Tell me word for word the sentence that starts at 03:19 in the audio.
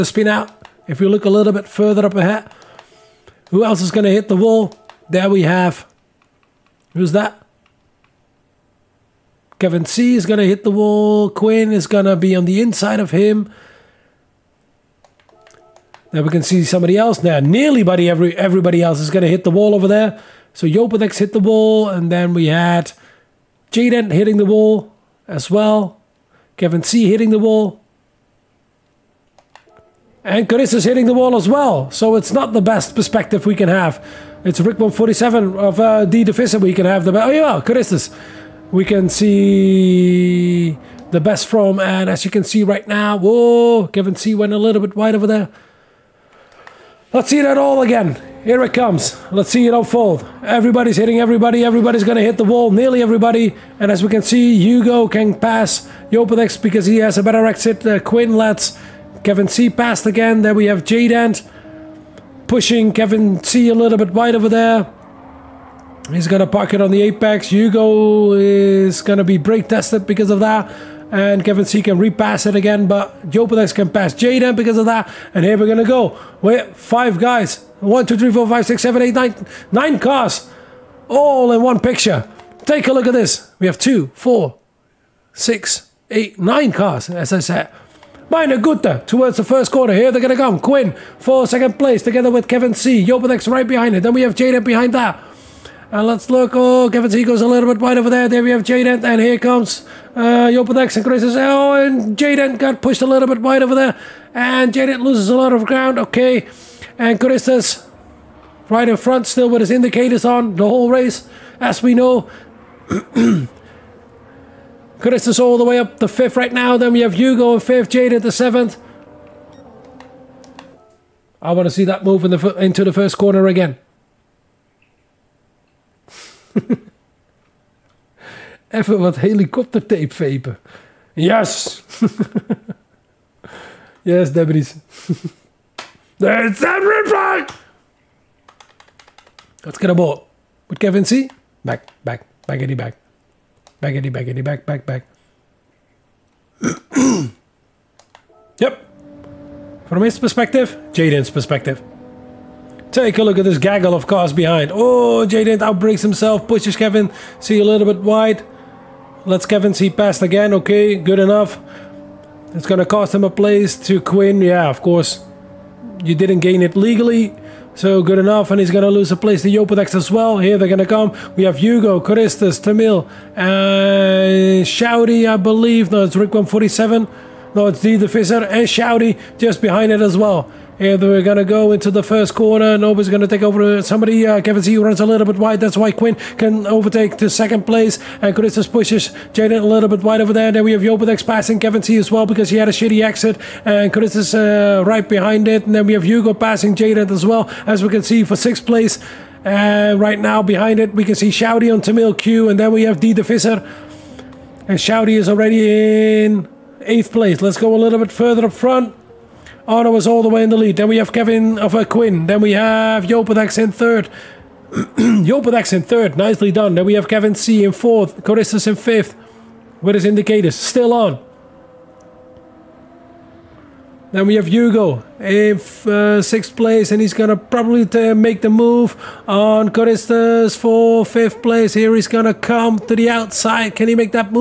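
And uh, right now behind it, we can see Shouty on Tamil Q.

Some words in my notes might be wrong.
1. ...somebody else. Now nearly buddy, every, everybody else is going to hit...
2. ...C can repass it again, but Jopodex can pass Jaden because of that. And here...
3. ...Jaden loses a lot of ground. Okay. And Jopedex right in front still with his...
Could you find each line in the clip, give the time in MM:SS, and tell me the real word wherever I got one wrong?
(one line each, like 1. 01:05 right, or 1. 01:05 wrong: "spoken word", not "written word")
1. 00:16 right
2. 01:11 right
3. 01:44 wrong: "Crisis", not "Jopedex".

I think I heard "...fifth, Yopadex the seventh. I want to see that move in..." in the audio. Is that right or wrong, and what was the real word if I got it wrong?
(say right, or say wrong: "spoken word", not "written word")
wrong: "Jaden", not "Yopadex".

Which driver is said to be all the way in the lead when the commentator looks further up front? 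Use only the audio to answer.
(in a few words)
Ottawa.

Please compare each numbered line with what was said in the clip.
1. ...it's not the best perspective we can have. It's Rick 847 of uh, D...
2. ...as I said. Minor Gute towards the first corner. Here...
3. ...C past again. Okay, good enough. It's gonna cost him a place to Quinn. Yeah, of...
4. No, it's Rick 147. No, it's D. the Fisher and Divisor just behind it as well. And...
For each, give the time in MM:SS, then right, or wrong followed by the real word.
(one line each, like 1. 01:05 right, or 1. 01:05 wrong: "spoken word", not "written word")
1. 00:32 wrong: "147", not "847"
2. 01:27 right
3. 02:39 right
4. 02:55 wrong: "Shouty", not "Divisor".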